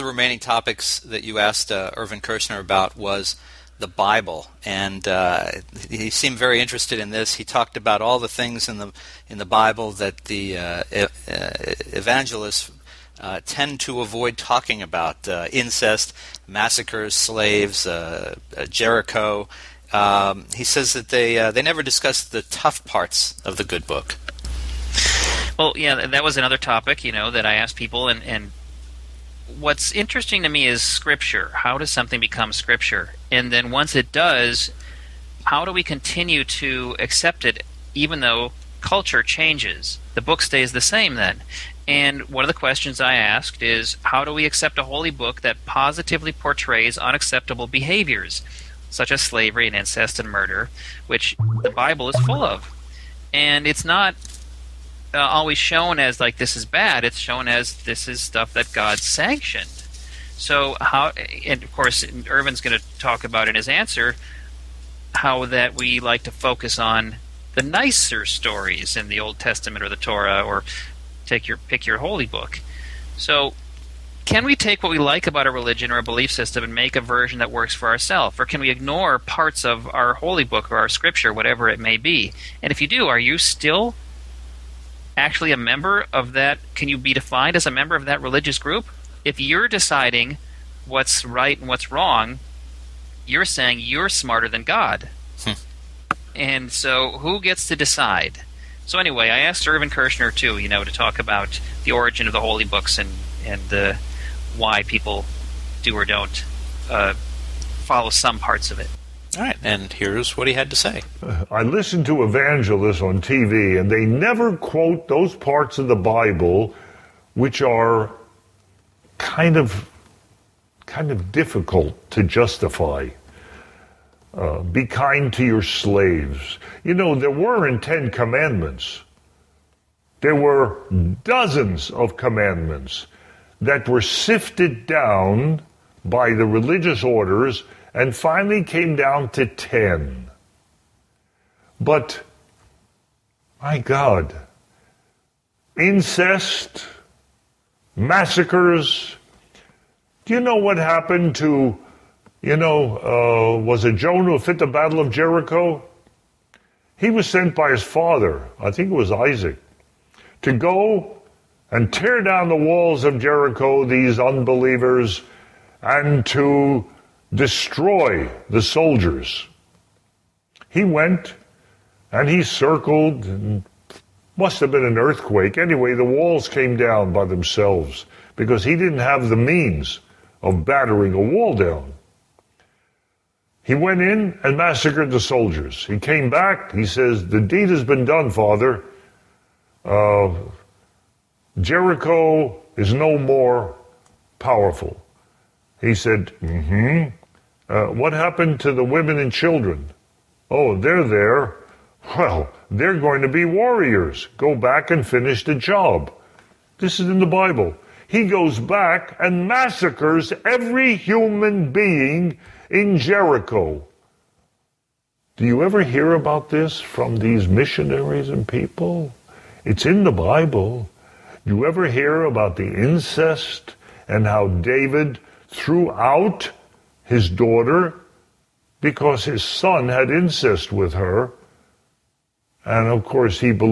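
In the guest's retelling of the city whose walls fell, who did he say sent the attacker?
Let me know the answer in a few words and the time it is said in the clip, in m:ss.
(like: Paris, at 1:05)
Isaac, at 2:39.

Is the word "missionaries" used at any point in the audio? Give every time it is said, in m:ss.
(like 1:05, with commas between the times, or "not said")
3:37.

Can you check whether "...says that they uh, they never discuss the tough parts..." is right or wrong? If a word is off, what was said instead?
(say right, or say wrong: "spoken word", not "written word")
right.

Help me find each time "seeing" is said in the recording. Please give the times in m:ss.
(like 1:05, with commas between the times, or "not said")
not said.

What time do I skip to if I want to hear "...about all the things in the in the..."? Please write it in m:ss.
0:07.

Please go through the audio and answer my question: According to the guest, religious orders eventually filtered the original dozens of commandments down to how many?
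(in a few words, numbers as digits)
10.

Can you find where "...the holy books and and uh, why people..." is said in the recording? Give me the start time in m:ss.
1:42.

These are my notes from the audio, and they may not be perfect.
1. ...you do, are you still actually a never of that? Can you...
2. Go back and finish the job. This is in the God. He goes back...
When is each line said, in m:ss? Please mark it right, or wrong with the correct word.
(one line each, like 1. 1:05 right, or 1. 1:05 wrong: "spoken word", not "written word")
1. 1:22 wrong: "member", not "never"
2. 3:24 wrong: "Bible", not "God".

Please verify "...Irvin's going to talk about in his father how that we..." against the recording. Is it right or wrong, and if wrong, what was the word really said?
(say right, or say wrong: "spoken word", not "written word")
wrong: "answer", not "father".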